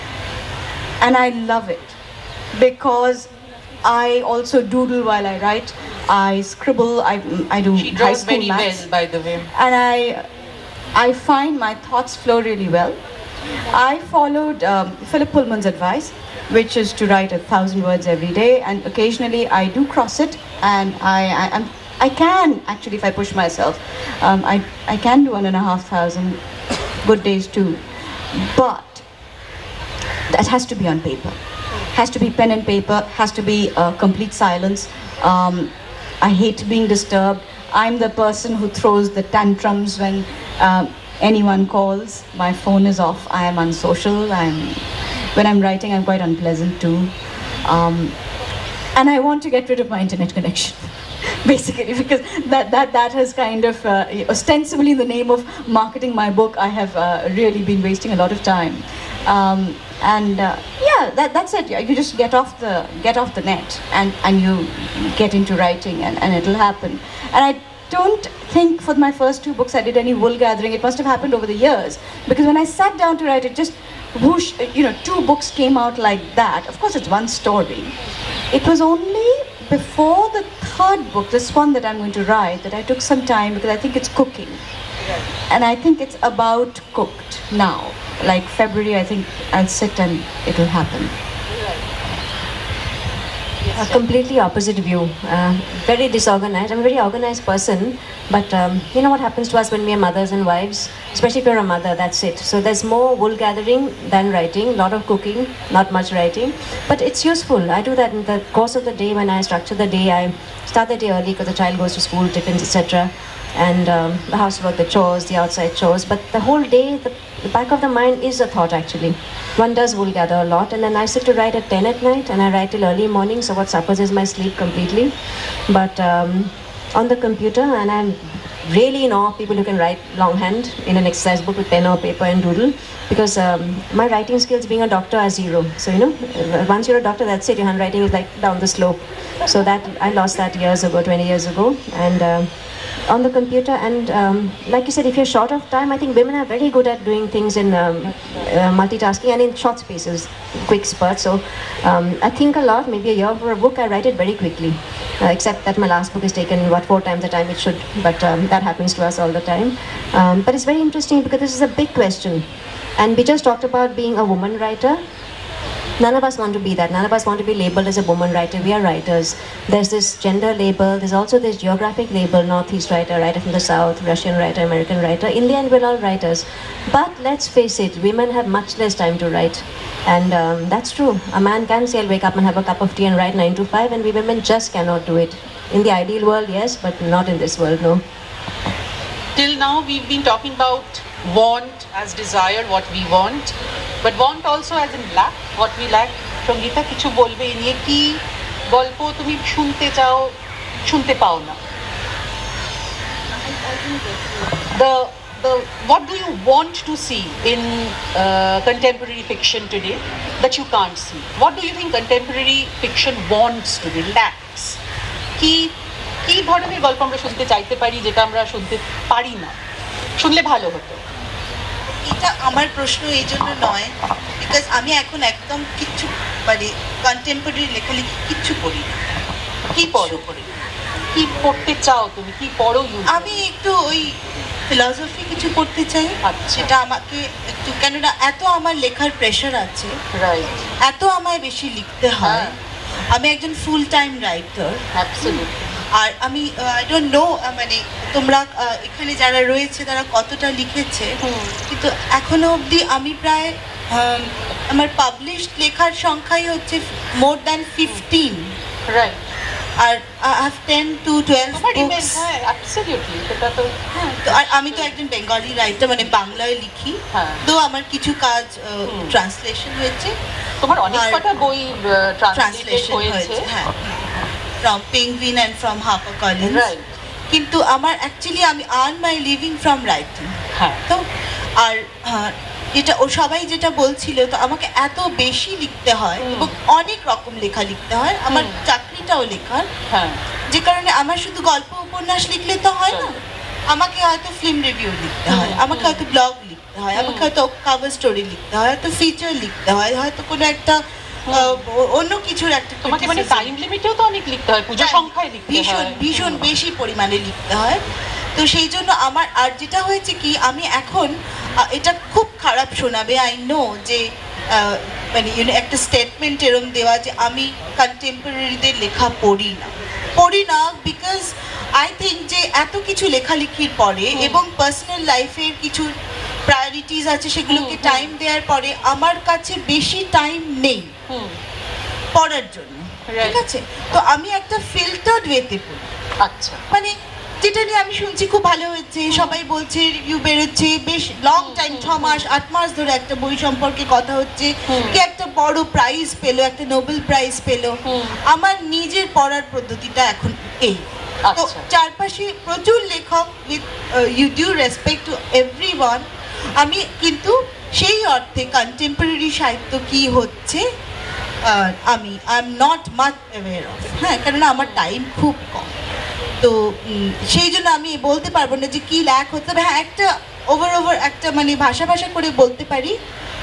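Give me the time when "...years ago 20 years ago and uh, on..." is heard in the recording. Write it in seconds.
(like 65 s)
140 s.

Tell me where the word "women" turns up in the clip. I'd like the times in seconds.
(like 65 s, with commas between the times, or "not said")
146 s, 178 s, 184 s.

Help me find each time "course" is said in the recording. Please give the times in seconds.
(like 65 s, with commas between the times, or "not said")
76 s, 108 s.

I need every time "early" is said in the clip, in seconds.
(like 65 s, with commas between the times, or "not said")
111 s, 122 s.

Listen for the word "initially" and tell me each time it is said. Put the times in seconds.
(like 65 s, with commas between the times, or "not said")
not said.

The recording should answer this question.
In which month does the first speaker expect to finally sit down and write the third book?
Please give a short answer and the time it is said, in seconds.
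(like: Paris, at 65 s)
February, at 88 s.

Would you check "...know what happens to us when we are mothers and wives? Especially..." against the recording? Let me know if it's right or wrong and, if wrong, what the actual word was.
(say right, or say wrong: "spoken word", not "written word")
right.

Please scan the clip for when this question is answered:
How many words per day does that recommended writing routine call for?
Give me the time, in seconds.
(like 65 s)
17 s.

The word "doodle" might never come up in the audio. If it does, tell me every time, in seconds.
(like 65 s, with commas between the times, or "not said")
4 s, 132 s.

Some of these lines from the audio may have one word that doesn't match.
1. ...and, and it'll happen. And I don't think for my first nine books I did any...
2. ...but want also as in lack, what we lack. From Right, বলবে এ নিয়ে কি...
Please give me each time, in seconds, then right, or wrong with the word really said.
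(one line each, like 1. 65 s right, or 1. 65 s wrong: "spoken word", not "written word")
1. 66 s wrong: "two", not "nine"
2. 194 s wrong: "Gita", not "Right".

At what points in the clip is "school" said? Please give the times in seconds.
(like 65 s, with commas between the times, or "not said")
8 s, 112 s.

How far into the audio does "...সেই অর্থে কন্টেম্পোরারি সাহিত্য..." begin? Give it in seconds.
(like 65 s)
357 s.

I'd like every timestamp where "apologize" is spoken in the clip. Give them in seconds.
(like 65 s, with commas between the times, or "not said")
not said.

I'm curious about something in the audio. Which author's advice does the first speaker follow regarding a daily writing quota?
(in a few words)
Philip Pullman.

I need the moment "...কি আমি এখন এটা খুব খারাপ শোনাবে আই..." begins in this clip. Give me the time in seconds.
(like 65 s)
310 s.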